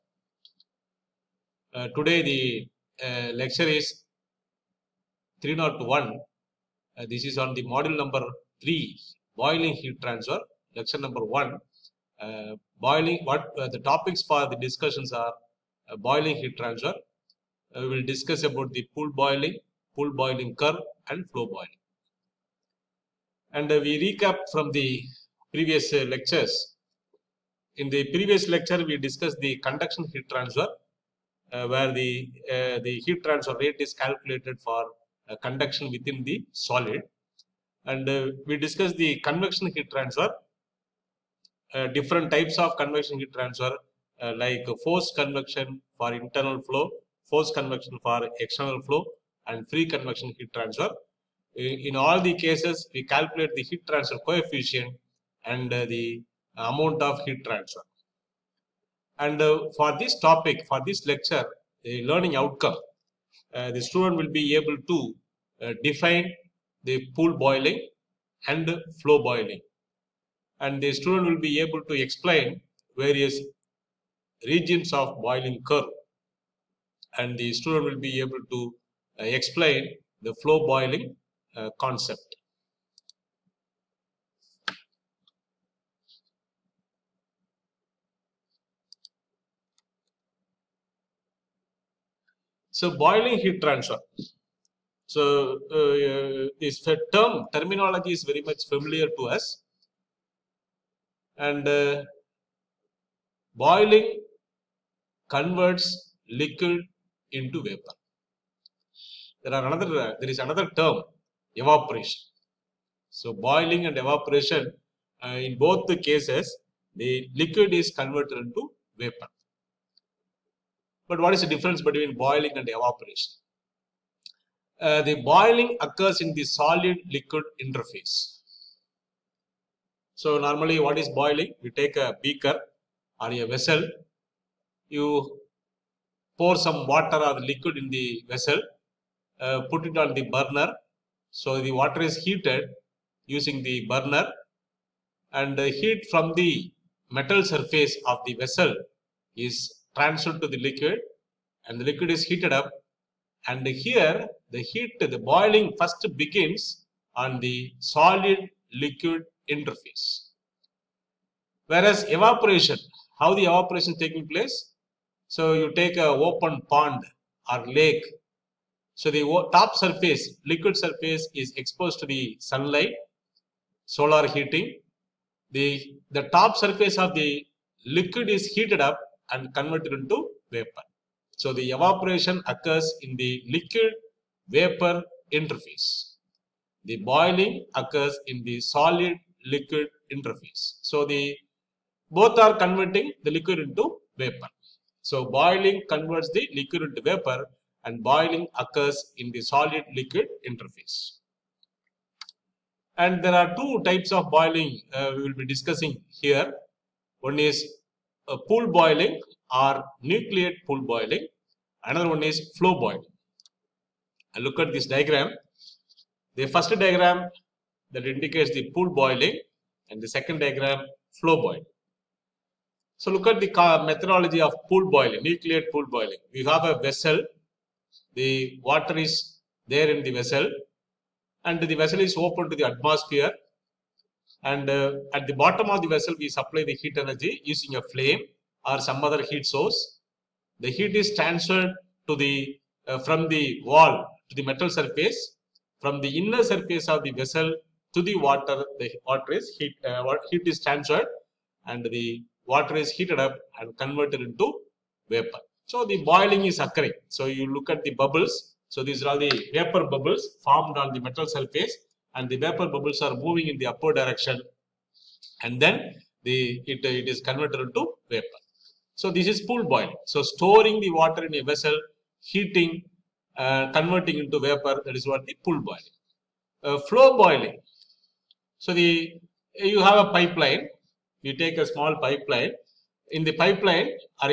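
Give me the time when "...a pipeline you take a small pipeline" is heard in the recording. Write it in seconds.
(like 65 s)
280 s.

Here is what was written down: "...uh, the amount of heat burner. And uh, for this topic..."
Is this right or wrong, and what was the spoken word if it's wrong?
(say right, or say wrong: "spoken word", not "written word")
wrong: "transfer", not "burner".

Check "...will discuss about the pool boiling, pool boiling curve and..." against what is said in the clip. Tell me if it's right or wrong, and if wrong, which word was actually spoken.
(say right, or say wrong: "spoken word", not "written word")
right.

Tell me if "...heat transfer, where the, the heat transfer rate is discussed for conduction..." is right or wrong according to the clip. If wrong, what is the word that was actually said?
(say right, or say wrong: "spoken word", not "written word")
wrong: "calculated", not "discussed".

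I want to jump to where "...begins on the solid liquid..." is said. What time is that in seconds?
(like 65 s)
156 s.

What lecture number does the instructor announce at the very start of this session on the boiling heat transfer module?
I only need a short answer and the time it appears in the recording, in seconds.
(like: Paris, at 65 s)
301, at 5 s.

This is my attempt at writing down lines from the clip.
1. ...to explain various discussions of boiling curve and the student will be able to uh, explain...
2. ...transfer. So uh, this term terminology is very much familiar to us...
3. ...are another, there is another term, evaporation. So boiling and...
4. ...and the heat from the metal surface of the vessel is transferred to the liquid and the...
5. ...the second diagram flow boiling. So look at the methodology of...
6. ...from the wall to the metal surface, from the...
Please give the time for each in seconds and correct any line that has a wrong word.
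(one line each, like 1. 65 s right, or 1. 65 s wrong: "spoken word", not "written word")
1. 71 s wrong: "regions", not "discussions"
2. 93 s right
3. 109 s right
4. 145 s right
5. 220 s right
6. 242 s right.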